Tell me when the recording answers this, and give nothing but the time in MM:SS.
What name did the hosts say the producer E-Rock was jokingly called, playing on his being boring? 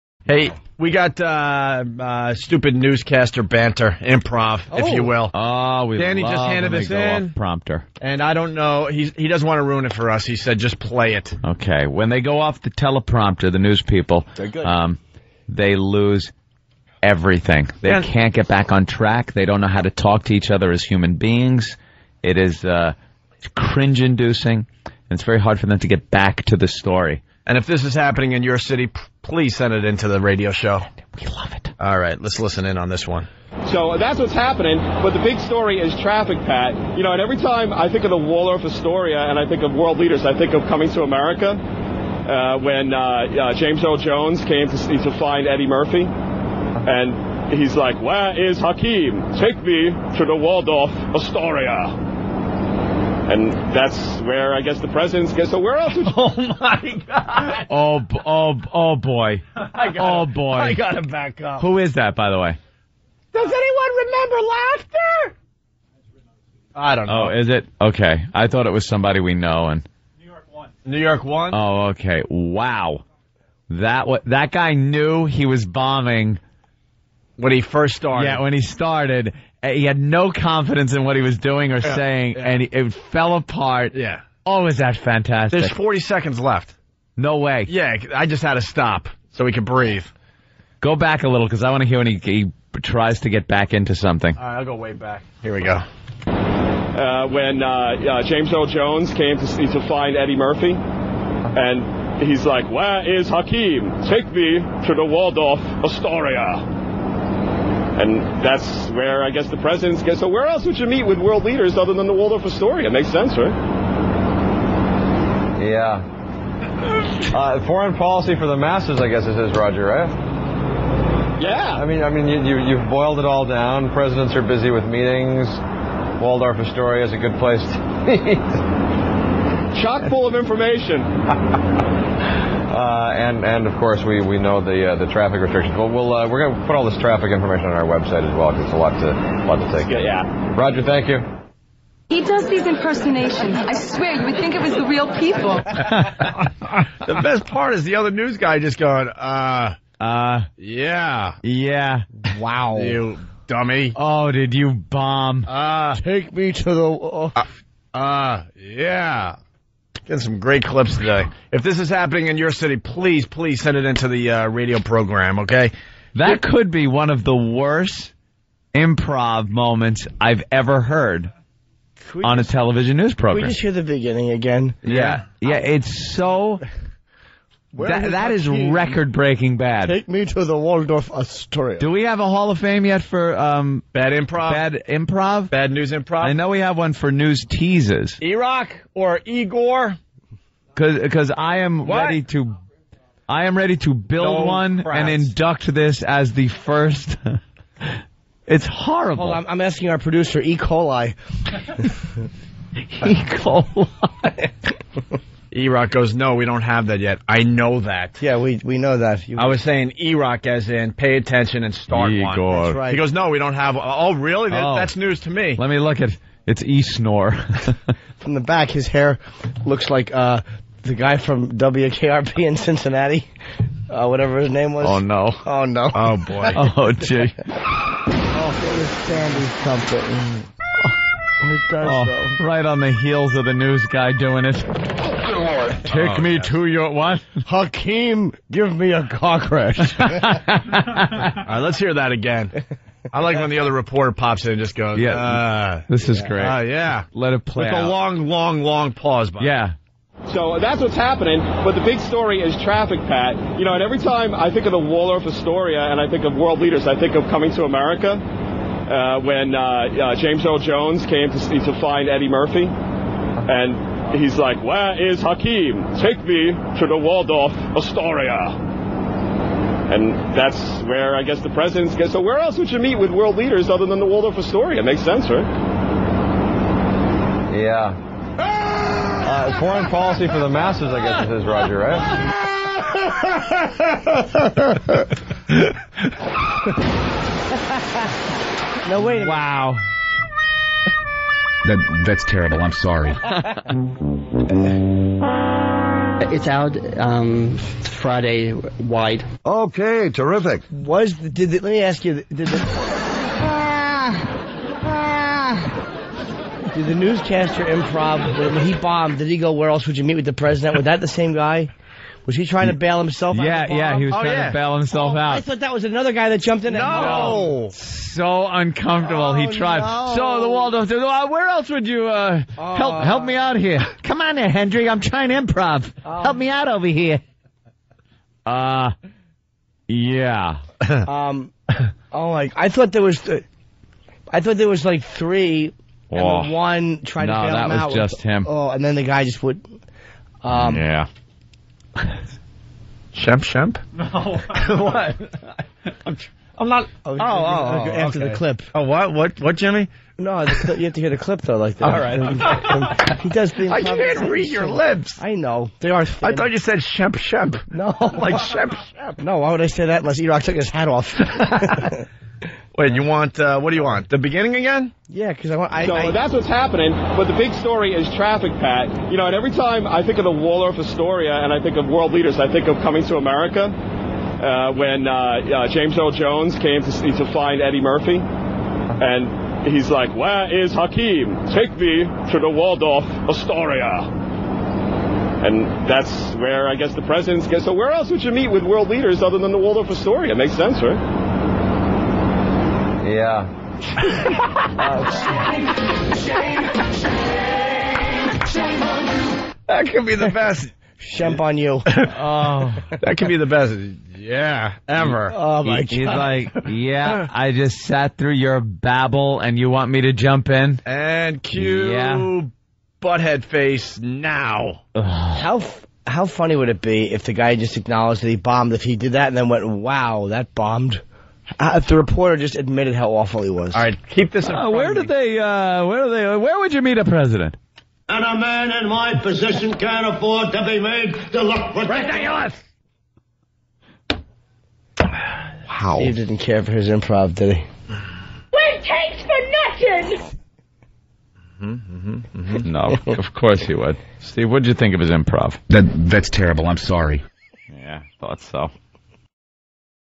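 03:36.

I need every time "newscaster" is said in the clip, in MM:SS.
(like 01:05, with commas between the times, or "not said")
00:02, 05:06.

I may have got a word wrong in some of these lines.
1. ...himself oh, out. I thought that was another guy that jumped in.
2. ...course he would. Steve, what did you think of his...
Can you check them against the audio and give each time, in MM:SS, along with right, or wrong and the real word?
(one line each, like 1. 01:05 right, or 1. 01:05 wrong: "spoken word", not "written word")
1. 05:14 right
2. 07:23 right.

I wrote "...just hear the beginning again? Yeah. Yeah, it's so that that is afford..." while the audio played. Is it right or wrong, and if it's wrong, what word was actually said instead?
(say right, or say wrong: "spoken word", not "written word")
wrong: "record", not "afford".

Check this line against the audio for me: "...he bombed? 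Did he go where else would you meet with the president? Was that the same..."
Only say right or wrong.
right.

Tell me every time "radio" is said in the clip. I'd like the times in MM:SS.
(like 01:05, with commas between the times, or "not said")
00:30, 02:44.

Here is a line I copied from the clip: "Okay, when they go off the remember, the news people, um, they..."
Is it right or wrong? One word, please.
wrong.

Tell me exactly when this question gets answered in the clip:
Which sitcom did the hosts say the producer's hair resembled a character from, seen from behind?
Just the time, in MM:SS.
03:41.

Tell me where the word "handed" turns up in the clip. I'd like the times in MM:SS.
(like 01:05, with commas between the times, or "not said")
00:06.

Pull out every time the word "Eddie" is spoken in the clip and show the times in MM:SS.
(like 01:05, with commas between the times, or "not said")
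00:45, 01:40, 04:22, 06:17.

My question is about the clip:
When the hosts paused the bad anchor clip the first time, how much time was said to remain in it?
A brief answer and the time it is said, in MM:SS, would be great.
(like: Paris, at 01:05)
40 seconds, at 01:25.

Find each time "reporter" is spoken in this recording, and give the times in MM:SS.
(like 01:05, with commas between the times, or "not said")
04:03, 07:01.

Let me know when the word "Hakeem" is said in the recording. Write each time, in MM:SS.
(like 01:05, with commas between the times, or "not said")
00:48, 01:43, 03:57, 04:25, 06:20.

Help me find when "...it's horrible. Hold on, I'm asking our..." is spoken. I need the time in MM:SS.
03:18.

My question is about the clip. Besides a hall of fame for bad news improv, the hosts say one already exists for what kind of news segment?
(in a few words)
news teases.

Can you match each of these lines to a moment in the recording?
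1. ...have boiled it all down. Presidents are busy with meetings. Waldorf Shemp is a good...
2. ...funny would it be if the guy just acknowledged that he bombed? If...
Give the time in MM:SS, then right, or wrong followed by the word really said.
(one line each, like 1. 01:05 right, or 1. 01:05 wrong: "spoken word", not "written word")
1. 02:02 wrong: "Astoria", not "Shemp"
2. 06:56 right.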